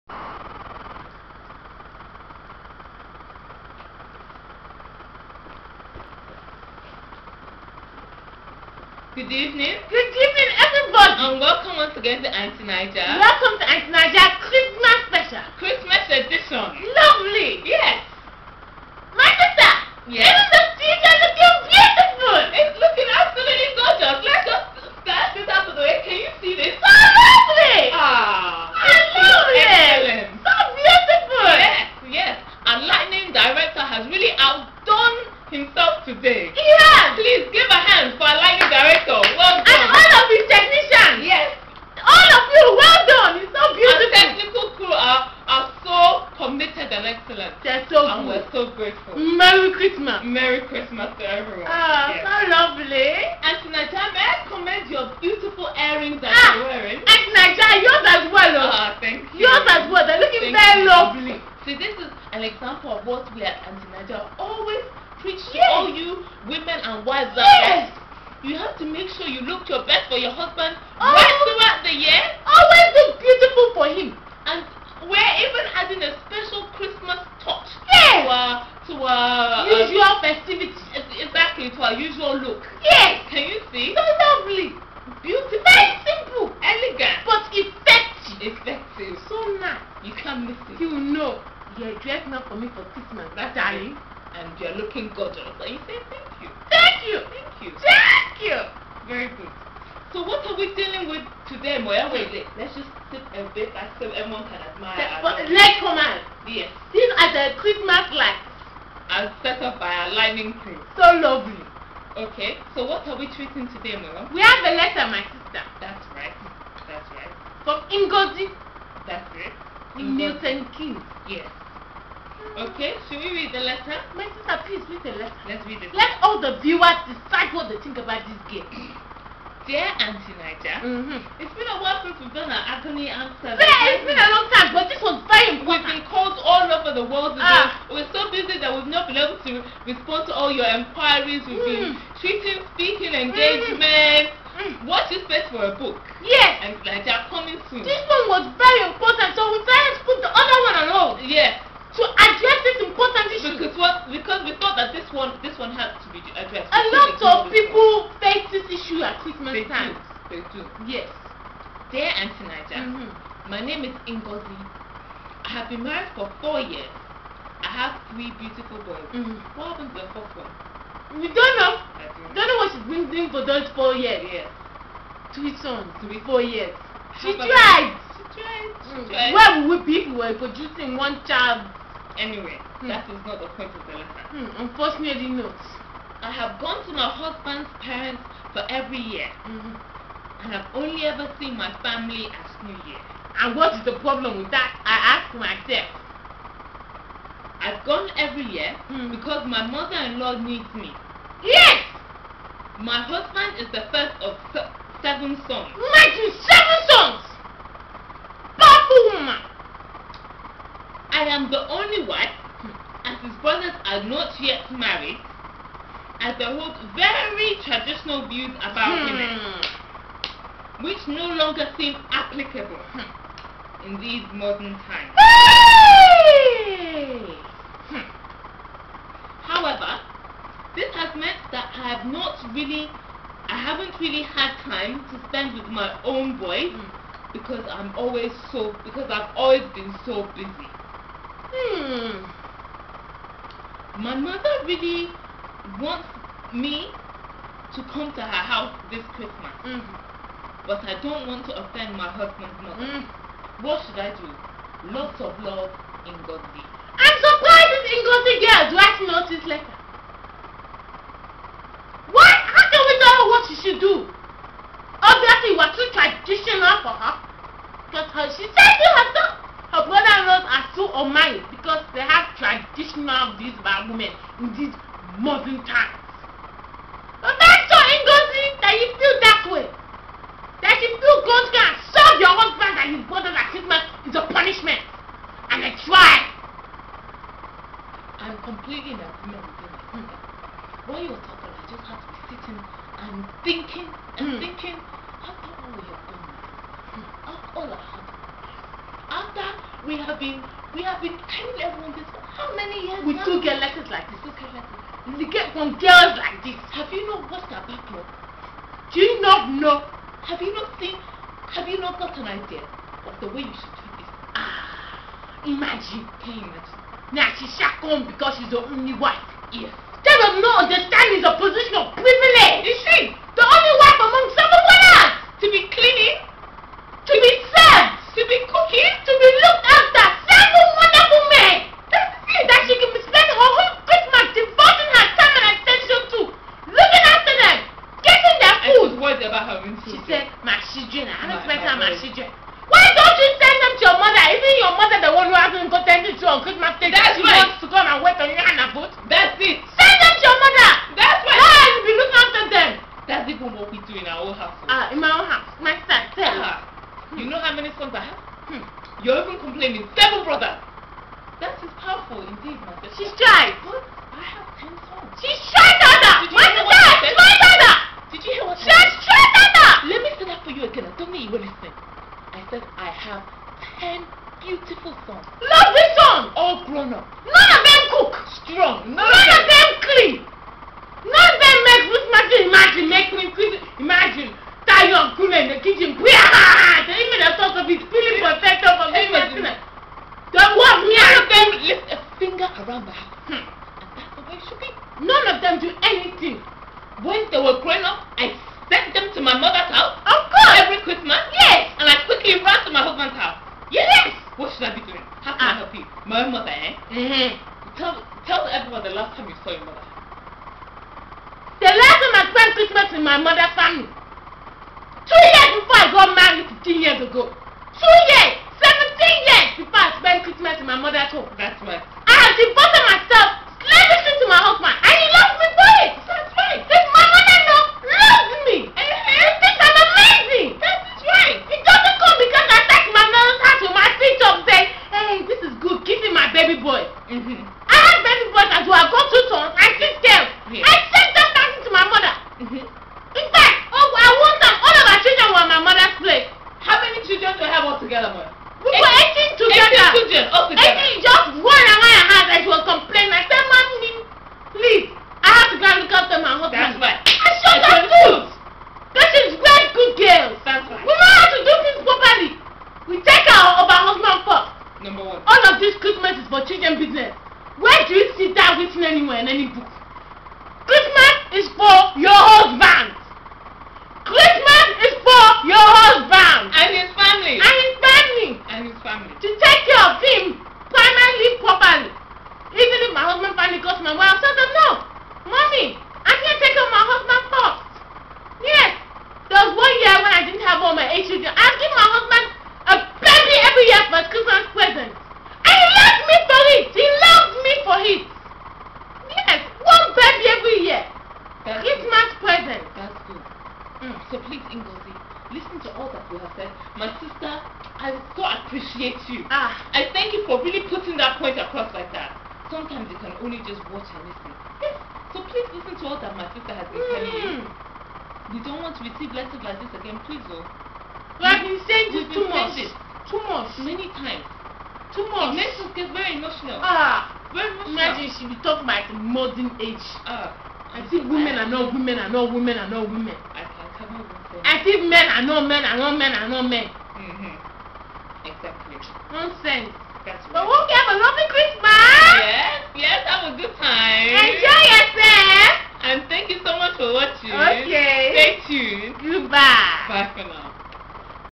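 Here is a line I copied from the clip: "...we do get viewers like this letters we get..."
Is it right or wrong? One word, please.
wrong.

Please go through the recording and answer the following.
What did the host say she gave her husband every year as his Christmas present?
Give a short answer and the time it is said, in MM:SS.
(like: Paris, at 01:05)
a baby, at 08:12.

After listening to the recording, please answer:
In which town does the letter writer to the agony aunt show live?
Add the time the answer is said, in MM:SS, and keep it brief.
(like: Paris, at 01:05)
Milton Keynes, at 02:00.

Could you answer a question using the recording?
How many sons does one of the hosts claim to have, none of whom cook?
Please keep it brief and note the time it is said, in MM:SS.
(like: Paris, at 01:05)
10, at 06:04.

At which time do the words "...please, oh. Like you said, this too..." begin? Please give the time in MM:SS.
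08:40.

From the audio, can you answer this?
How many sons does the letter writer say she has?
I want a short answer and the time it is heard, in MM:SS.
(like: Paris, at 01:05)
3, at 02:48.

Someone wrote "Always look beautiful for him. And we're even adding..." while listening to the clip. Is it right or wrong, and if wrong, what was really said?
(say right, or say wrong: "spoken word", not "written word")
right.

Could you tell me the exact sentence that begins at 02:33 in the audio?
Because, what, because we thought that this one this one has to be addressed.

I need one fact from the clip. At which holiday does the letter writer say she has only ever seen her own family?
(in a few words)
New Year.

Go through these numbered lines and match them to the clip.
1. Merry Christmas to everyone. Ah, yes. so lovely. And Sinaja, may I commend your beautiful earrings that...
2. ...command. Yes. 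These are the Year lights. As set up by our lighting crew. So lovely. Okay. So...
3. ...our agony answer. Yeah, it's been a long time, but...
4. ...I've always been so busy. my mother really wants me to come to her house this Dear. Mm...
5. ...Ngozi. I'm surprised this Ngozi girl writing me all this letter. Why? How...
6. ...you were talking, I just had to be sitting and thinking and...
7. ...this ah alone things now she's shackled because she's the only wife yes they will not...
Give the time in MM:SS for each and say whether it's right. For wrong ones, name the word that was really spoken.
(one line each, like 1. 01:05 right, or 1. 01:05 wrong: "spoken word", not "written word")
1. 00:50 right
2. 01:45 wrong: "Christmas", not "Year"
3. 02:12 right
4. 03:59 wrong: "Christmas", not "Dear"
5. 04:16 right
6. 04:51 right
7. 05:13 wrong: "imagine", not "alone".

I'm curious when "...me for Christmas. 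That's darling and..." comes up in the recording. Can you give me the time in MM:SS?
01:32.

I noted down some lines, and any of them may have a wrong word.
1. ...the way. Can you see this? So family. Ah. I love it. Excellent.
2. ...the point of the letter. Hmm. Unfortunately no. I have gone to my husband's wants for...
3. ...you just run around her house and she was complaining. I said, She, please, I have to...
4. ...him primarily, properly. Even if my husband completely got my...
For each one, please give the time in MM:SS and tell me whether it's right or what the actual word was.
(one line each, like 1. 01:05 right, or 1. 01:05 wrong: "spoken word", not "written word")
1. 00:25 wrong: "lovely", not "family"
2. 03:03 wrong: "parents", not "wants"
3. 07:30 wrong: "Mommy", not "She"
4. 08:00 wrong: "finally", not "completely".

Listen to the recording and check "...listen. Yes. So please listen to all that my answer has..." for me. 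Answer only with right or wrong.
wrong.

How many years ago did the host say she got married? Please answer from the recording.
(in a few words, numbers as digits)
15.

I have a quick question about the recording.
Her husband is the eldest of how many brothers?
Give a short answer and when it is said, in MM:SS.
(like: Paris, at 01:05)
7, at 03:24.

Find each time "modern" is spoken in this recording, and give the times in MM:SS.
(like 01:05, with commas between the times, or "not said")
03:44, 04:35, 08:48.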